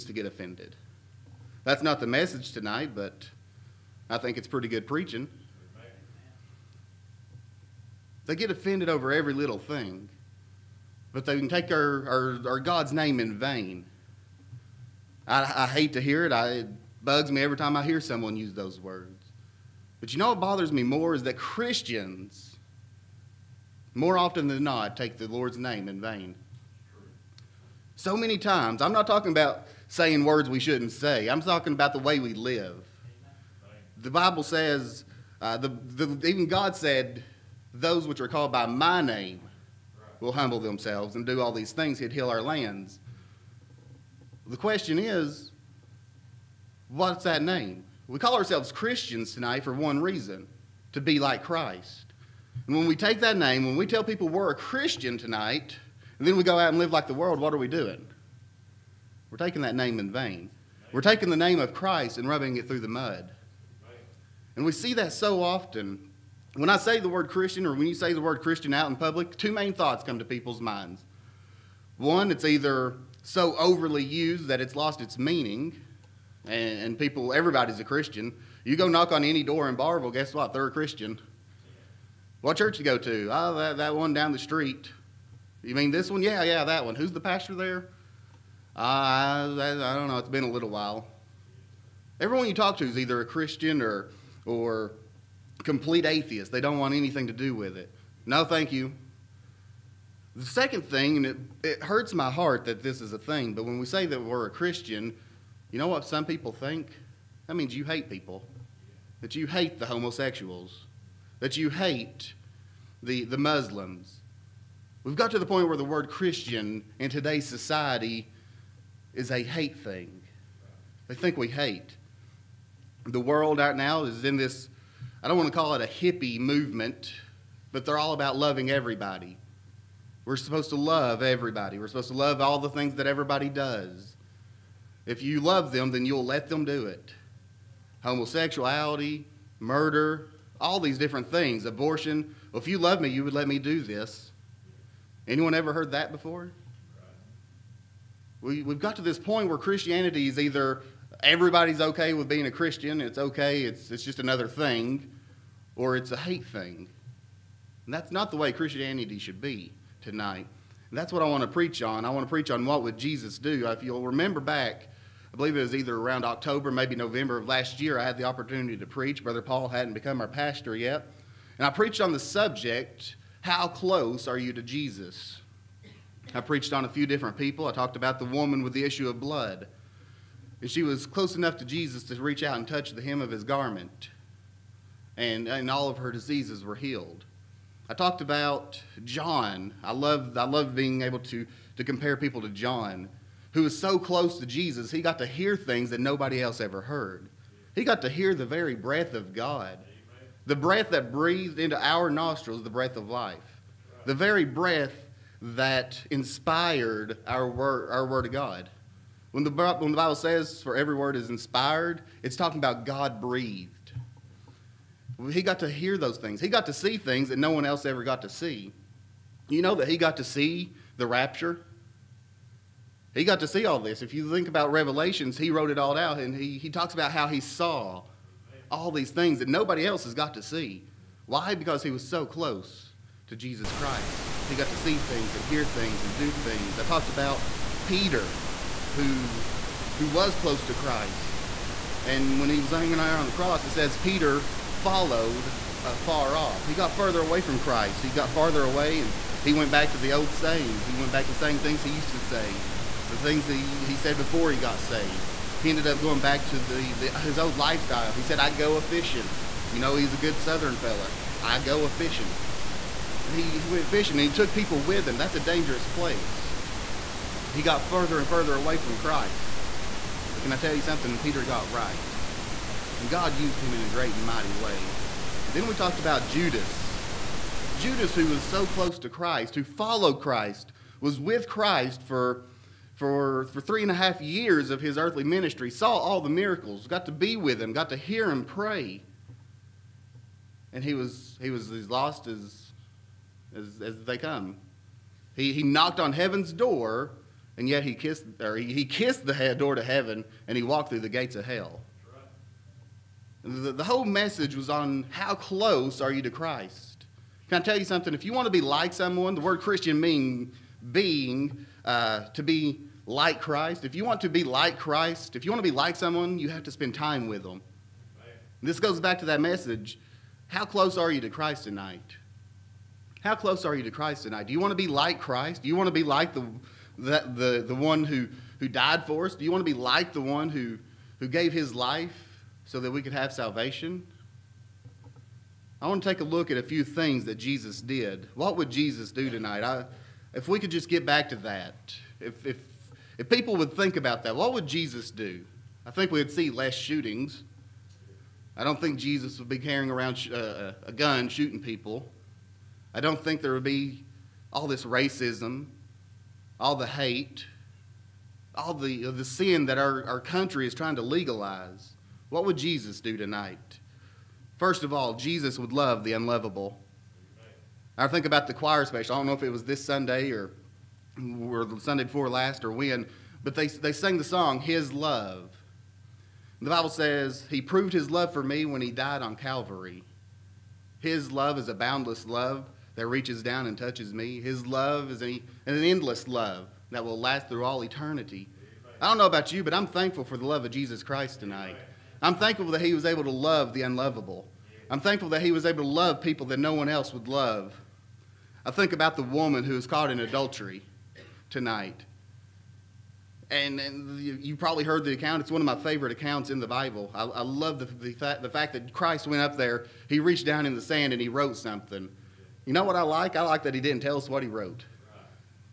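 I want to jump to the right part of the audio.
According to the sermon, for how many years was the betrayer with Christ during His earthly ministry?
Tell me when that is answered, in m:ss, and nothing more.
4:43.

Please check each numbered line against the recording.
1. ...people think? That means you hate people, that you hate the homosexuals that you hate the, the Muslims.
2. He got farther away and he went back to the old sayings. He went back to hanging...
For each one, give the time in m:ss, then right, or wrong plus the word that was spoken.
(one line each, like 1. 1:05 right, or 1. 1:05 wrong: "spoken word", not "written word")
1. 1:46 right
2. 4:08 wrong: "saying", not "hanging".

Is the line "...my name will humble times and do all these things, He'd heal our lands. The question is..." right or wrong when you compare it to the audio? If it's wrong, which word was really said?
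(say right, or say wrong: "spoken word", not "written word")
wrong: "themselves", not "times".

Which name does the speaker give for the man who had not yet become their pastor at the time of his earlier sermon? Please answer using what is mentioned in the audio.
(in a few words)
Brother Paul.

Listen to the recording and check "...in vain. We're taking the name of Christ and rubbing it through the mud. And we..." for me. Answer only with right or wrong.
right.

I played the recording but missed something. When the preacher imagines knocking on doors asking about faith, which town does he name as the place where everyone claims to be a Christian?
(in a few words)
Barbourville.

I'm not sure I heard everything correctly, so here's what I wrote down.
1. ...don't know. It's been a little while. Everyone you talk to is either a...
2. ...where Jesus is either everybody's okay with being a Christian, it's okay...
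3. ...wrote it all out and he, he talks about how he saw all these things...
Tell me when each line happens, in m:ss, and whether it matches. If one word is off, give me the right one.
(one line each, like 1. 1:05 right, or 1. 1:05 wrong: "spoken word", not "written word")
1. 1:29 right
2. 2:29 wrong: "Christianity", not "Jesus"
3. 3:45 right.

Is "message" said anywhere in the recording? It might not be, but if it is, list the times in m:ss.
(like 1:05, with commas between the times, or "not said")
0:02, 5:04, 5:19.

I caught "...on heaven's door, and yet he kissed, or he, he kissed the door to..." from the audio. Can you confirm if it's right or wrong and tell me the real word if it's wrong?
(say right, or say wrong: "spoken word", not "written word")
right.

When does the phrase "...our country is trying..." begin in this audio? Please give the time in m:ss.
6:00.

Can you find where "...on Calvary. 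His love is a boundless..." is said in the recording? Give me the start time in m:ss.
6:19.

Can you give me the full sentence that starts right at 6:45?
It's one of my favorite accounts in the Bible.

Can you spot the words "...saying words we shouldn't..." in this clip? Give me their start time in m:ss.
0:29.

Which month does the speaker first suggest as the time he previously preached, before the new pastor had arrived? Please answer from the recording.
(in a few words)
October.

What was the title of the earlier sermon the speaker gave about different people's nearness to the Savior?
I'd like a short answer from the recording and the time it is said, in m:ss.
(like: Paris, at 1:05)
How Close Are You to Jesus?, at 2:53.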